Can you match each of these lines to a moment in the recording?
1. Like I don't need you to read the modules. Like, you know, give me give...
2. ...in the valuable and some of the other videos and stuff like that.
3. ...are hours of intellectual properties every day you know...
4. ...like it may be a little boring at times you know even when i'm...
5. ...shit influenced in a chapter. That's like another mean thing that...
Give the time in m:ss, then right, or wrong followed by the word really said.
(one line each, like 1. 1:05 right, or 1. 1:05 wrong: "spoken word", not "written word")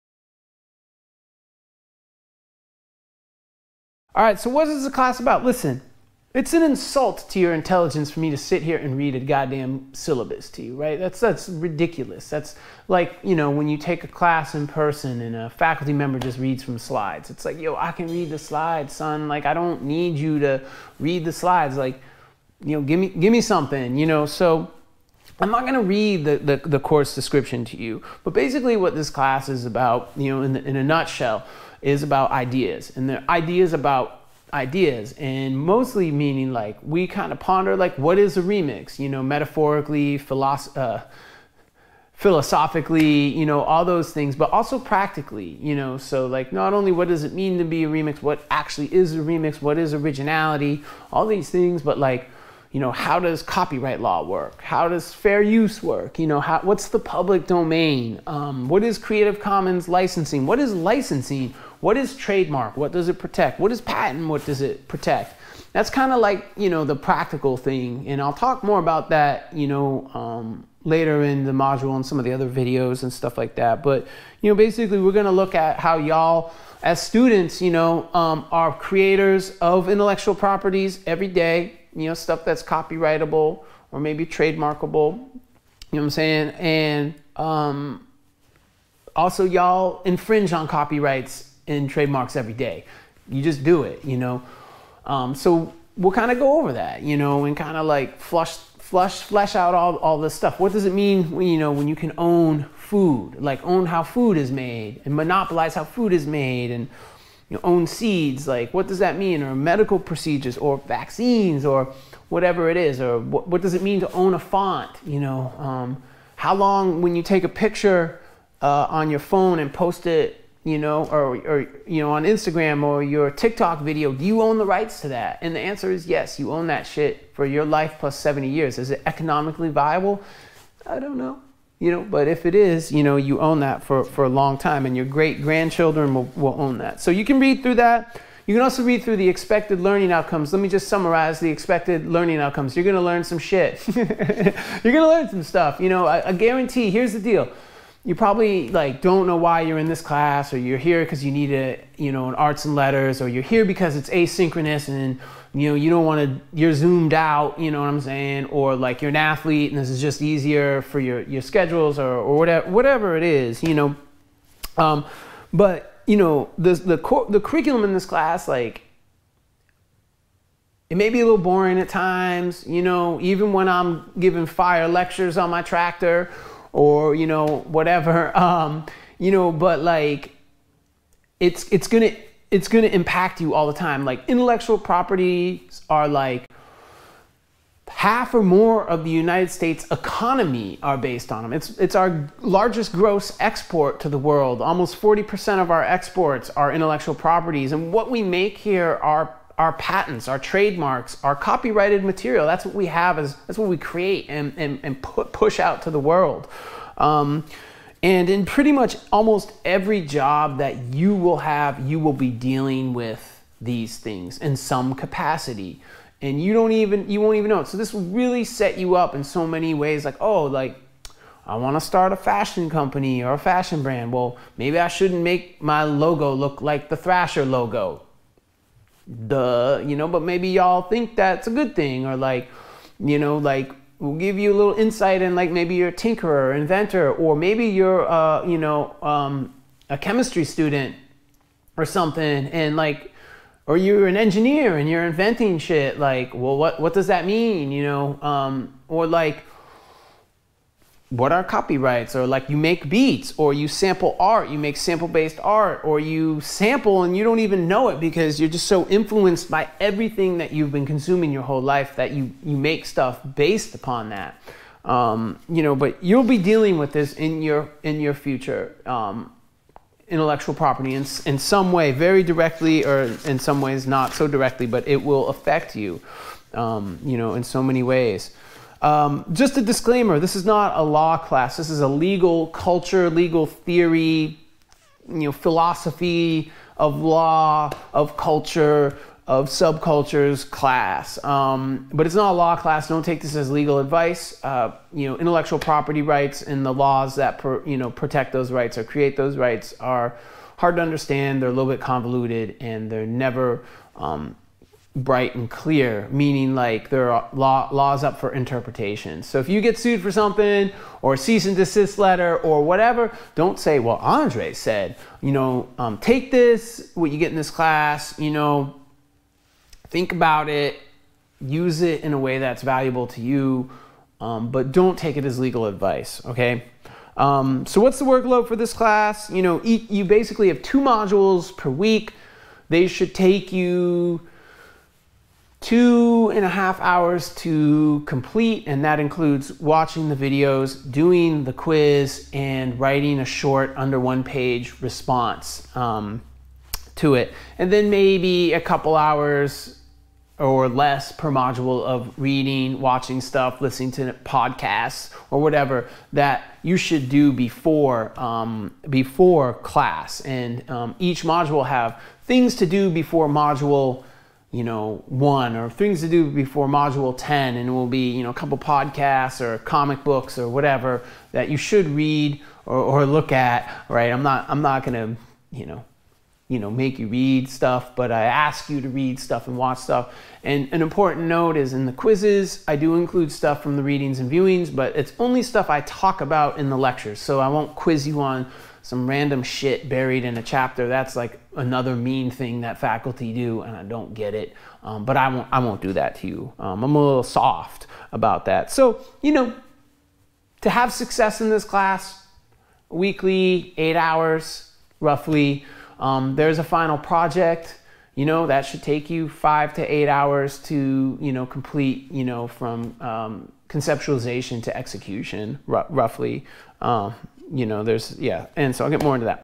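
1. 0:19 wrong: "slides", not "modules"
2. 1:11 wrong: "module", not "valuable"
3. 1:18 wrong: "creators", not "hours"
4. 2:48 right
5. 6:29 wrong: "buried", not "influenced".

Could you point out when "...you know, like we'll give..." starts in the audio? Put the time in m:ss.
3:52.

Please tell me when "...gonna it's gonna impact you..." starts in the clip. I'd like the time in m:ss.
3:01.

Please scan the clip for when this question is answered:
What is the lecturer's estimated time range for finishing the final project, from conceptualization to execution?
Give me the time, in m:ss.
6:49.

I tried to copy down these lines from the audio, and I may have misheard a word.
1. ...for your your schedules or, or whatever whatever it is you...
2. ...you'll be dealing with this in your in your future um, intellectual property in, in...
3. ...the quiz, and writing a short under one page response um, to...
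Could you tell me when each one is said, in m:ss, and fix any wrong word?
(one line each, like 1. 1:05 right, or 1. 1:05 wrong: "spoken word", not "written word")
1. 2:40 right
2. 4:26 right
3. 5:41 right.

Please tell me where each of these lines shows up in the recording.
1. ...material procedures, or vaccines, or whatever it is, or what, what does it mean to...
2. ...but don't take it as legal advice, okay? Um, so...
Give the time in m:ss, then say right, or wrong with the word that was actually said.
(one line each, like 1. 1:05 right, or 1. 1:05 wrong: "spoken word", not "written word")
1. 1:49 wrong: "medical", not "material"
2. 5:24 right.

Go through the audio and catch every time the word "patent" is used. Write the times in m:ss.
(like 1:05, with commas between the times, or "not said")
1:03, 3:19.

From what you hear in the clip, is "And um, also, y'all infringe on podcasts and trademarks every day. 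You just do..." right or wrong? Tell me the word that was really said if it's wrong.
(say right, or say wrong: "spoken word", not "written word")
wrong: "copyrights", not "podcasts".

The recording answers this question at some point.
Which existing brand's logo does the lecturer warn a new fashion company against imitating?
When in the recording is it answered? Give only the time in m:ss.
3:46.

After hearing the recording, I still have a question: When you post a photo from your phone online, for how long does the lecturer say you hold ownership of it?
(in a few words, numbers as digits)
Your life plus 70 years.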